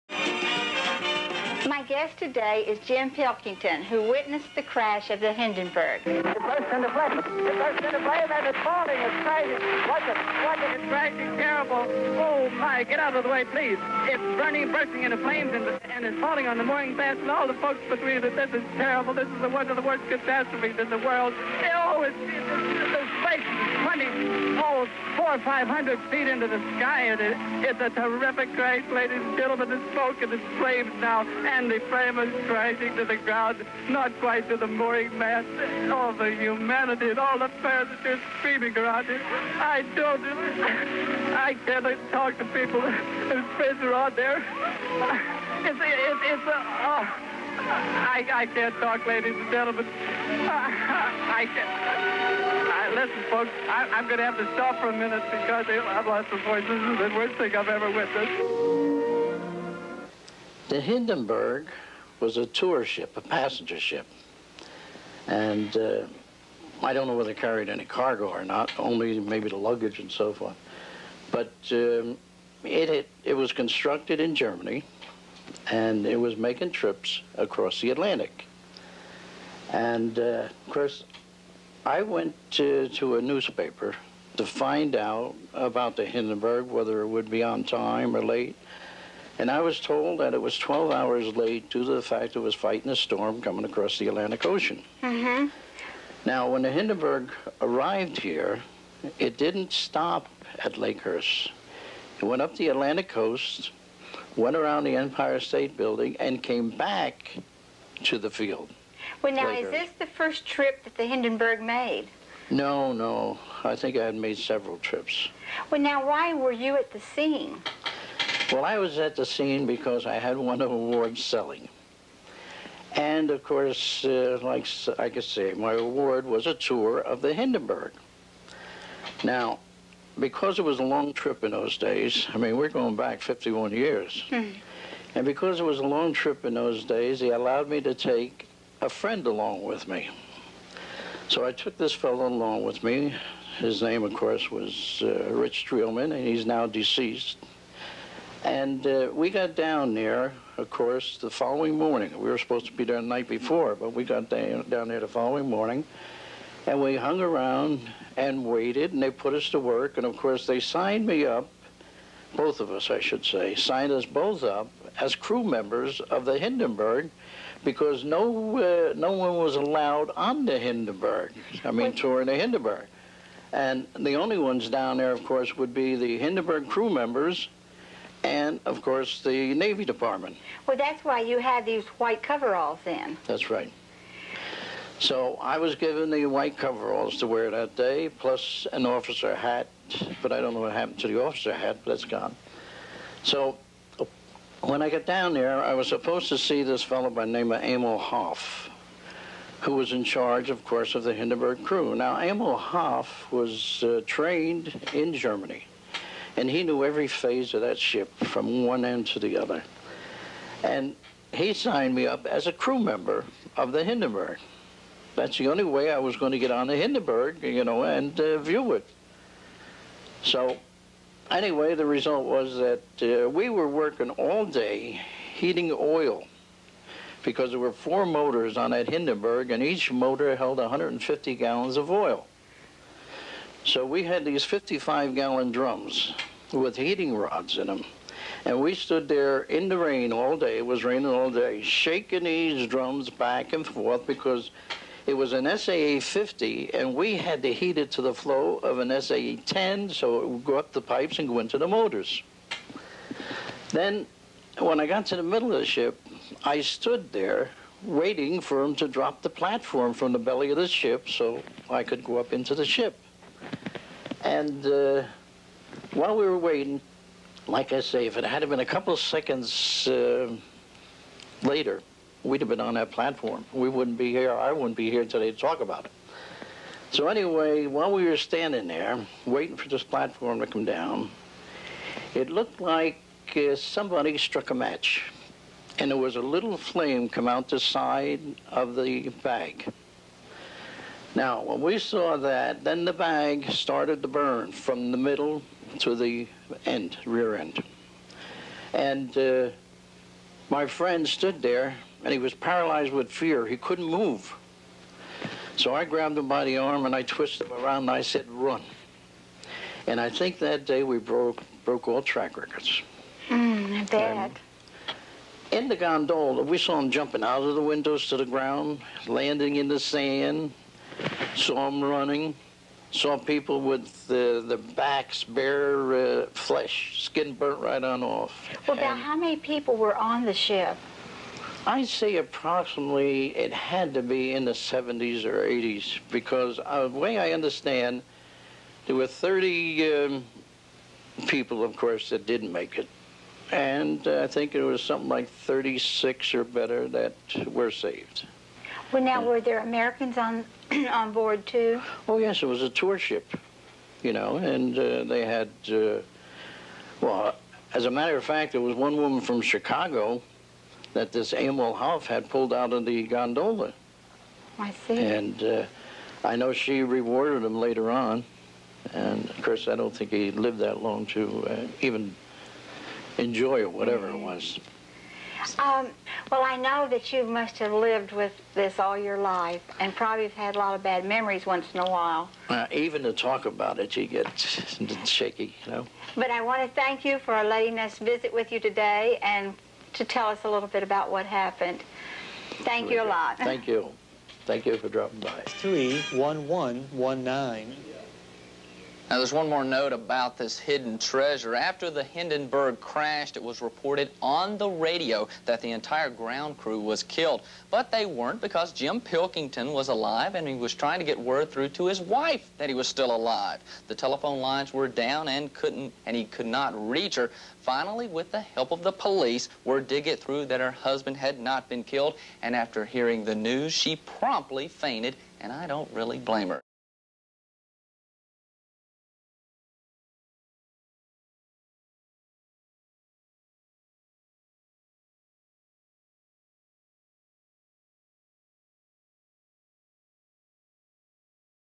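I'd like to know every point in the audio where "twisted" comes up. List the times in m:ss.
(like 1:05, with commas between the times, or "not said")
5:07.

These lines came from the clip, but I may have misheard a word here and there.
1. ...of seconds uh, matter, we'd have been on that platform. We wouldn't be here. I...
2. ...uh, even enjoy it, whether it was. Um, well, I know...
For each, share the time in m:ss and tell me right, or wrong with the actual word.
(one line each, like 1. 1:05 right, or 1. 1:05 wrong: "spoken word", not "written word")
1. 4:28 wrong: "later", not "matter"
2. 6:11 wrong: "whatever", not "whether".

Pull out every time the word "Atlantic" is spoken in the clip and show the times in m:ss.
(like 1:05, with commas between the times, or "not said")
1:17, 1:34, 1:42.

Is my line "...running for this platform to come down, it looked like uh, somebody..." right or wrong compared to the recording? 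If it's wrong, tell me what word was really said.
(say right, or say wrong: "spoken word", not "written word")
wrong: "waiting", not "running".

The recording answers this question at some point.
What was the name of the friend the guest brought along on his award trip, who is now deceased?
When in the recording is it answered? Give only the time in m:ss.
2:25.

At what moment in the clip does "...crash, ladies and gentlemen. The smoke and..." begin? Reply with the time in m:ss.
0:28.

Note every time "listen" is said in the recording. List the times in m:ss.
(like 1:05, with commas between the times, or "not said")
0:52.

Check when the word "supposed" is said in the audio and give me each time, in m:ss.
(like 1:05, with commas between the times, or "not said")
2:32, 3:15.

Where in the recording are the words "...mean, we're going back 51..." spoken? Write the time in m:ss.
2:12.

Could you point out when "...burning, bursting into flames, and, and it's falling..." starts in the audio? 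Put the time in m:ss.
0:14.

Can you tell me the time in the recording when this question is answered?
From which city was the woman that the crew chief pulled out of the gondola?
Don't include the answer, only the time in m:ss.
5:59.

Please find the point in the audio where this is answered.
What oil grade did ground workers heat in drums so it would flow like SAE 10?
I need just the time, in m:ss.
4:05.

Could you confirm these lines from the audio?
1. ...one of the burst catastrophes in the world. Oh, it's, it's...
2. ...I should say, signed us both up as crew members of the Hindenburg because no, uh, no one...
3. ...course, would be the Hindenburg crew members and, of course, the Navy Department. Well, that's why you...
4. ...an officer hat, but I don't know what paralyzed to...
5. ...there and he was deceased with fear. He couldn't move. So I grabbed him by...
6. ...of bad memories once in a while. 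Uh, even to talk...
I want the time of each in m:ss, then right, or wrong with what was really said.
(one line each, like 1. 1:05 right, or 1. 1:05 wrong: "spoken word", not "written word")
1. 0:19 wrong: "worst", not "burst"
2. 2:42 right
3. 2:55 right
4. 3:08 wrong: "happened", not "paralyzed"
5. 5:01 wrong: "paralyzed", not "deceased"
6. 6:20 right.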